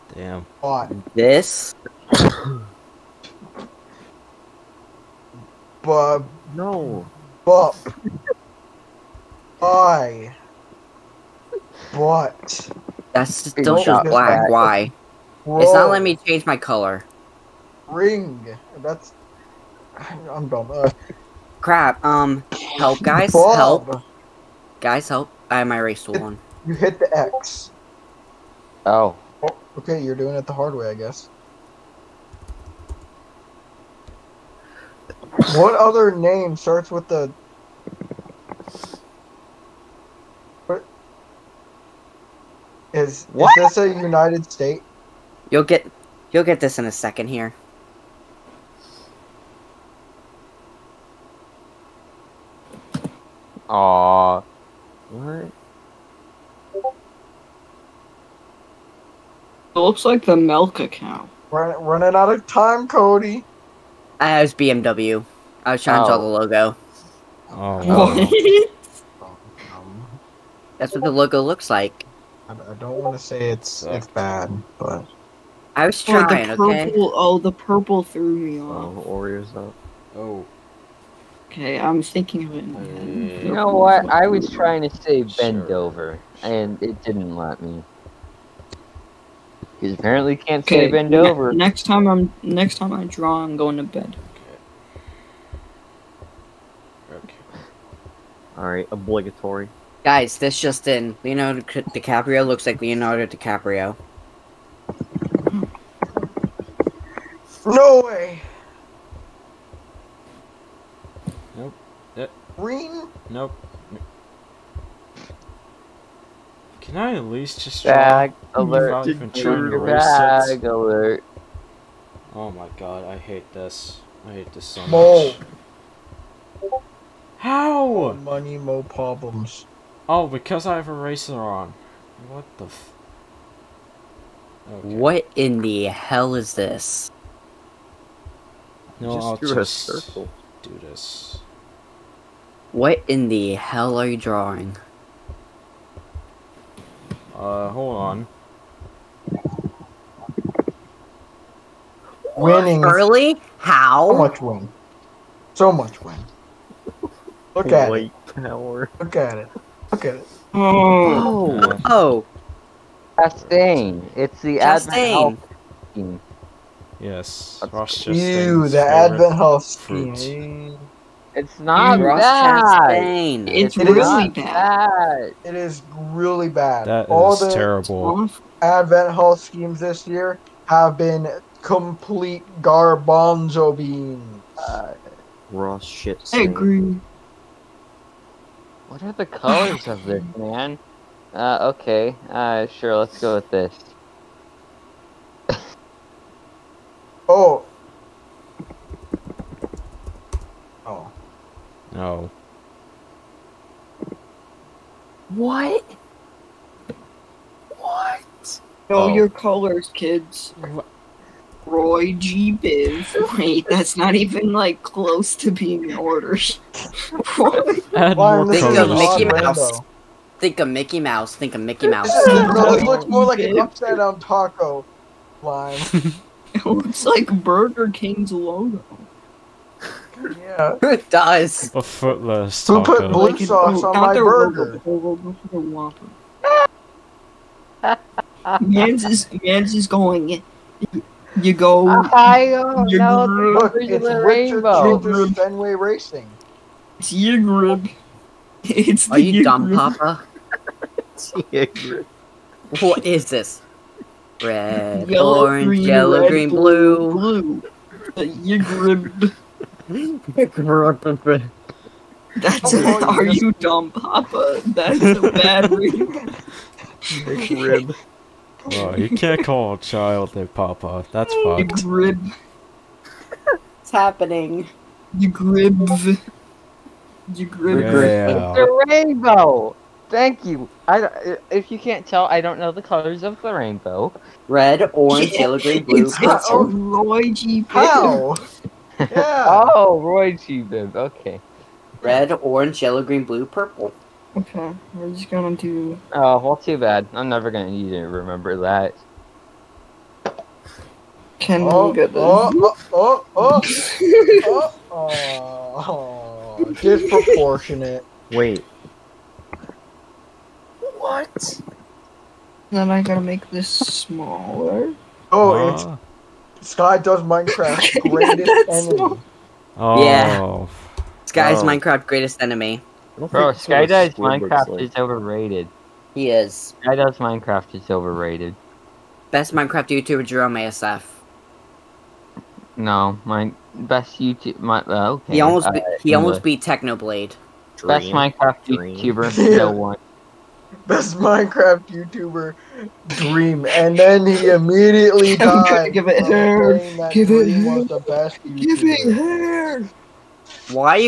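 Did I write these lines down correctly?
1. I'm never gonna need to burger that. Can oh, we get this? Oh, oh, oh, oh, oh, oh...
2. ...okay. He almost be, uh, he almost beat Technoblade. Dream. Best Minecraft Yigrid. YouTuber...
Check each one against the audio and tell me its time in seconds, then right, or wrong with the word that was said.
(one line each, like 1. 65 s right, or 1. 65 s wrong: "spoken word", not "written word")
1. 297 s wrong: "remember", not "burger"
2. 335 s wrong: "Dream", not "Yigrid".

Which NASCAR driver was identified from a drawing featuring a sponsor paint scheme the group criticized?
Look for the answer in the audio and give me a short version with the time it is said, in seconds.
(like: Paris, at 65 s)
Ross Chastain, at 167 s.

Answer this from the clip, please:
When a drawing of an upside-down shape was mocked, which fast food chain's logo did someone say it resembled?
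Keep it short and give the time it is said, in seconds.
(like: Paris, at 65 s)
Burger King, at 227 s.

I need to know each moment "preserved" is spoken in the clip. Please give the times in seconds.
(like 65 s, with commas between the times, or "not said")
not said.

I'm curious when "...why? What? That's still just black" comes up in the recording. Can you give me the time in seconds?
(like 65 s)
9 s.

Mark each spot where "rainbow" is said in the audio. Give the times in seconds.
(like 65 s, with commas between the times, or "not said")
278 s, 283 s.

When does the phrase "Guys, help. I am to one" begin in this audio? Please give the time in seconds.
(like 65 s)
24 s.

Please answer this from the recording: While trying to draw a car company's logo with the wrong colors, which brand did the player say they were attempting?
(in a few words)
BMW.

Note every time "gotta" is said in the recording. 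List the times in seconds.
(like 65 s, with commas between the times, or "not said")
313 s.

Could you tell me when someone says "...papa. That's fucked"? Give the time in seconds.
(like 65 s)
270 s.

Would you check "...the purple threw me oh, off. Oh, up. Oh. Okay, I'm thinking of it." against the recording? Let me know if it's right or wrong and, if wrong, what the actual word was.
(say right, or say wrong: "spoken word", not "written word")
right.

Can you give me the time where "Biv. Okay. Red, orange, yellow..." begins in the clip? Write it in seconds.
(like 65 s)
290 s.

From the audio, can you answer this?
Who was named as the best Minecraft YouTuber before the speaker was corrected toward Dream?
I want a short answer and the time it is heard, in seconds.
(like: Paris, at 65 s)
Jerome ASF, at 330 s.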